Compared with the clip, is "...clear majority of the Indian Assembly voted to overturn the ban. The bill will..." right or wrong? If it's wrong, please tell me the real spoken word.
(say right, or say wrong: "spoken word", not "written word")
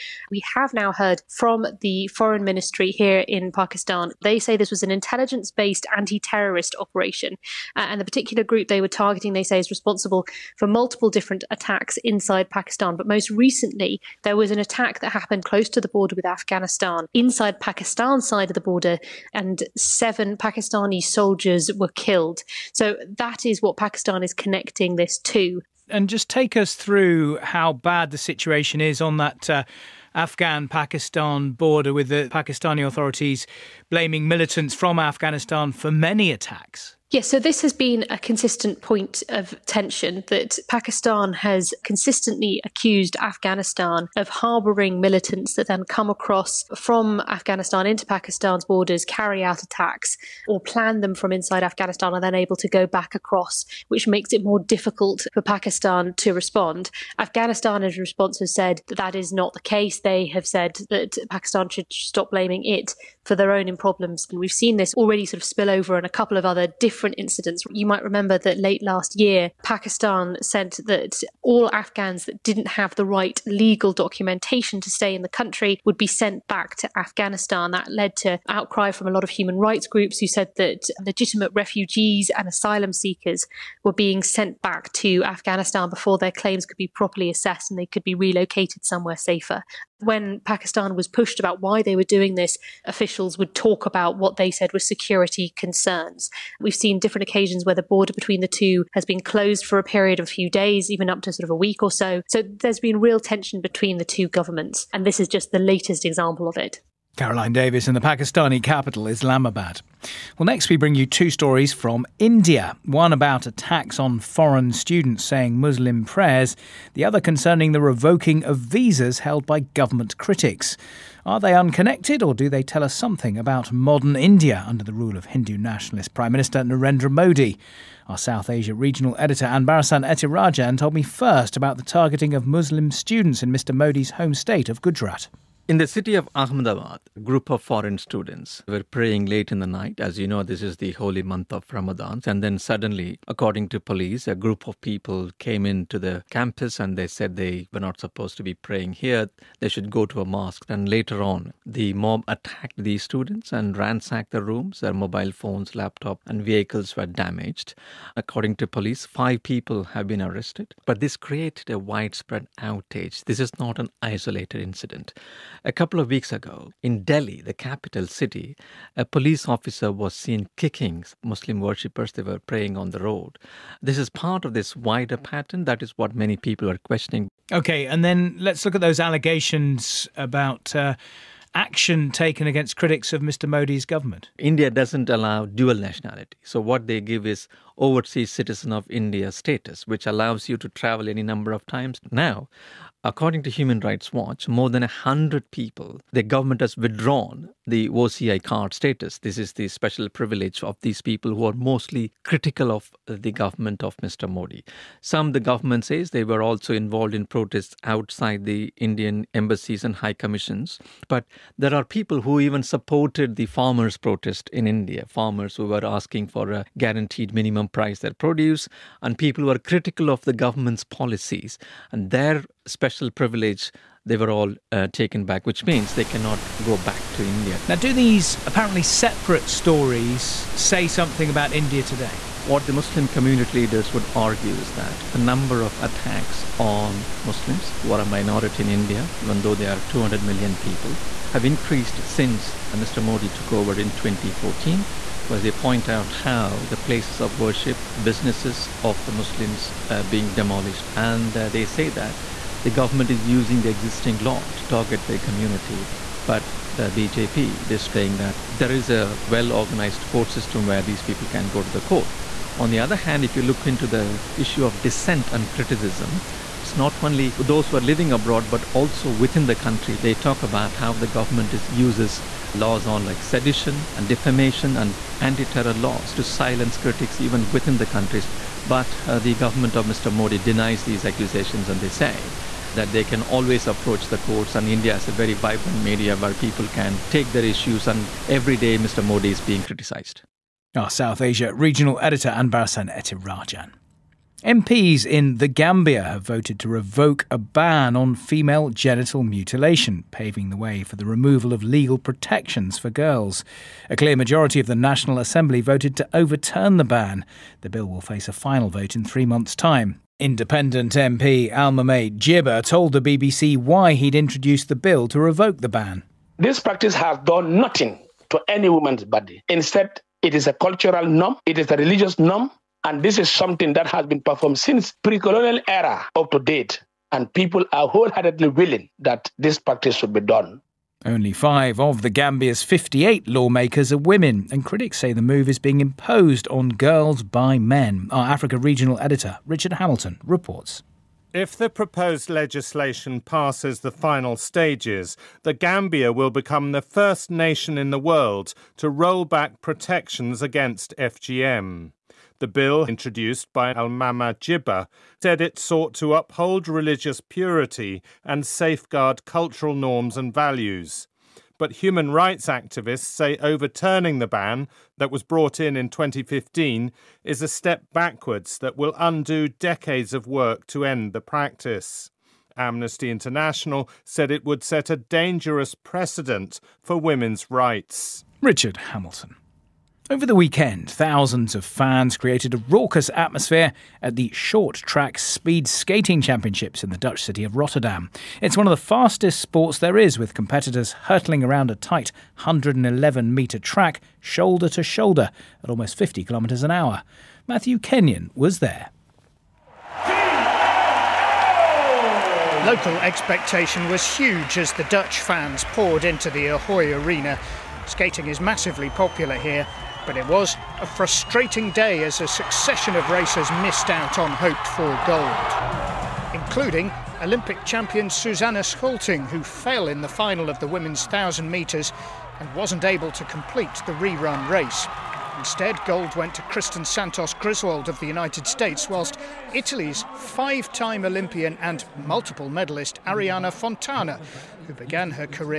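wrong: "National", not "Indian".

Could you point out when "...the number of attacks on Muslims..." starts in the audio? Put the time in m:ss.
3:55.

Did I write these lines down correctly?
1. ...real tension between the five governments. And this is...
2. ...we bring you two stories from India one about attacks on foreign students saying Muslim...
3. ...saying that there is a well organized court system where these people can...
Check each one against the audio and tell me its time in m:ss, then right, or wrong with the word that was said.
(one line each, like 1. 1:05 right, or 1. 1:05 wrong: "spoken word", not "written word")
1. 1:43 wrong: "two", not "five"
2. 1:50 right
3. 4:17 right.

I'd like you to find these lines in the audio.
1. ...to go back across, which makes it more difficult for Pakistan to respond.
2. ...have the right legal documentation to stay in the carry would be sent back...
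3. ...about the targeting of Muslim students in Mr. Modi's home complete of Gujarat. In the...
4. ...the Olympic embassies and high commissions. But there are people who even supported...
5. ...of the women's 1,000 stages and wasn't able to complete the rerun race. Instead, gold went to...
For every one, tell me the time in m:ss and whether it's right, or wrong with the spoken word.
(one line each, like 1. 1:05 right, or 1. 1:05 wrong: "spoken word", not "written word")
1. 0:52 right
2. 1:12 wrong: "country", not "carry"
3. 2:11 wrong: "state", not "complete"
4. 3:28 wrong: "Indian", not "Olympic"
5. 7:00 wrong: "metres", not "stages".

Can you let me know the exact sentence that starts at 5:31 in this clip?
Only five of the Gambia's 58 lawmakers are women, and critics say the move is being imposed on girls by men.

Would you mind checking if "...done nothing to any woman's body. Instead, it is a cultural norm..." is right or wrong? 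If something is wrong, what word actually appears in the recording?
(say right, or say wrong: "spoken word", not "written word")
right.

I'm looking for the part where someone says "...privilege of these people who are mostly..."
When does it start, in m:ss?
3:20.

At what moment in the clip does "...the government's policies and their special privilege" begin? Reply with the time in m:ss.
3:40.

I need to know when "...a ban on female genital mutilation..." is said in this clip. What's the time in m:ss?
4:57.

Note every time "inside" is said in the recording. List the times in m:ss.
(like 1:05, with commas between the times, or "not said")
0:12, 0:17, 0:51.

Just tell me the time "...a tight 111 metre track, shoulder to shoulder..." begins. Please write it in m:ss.
6:31.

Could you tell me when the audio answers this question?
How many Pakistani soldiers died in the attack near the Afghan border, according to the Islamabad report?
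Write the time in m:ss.
0:19.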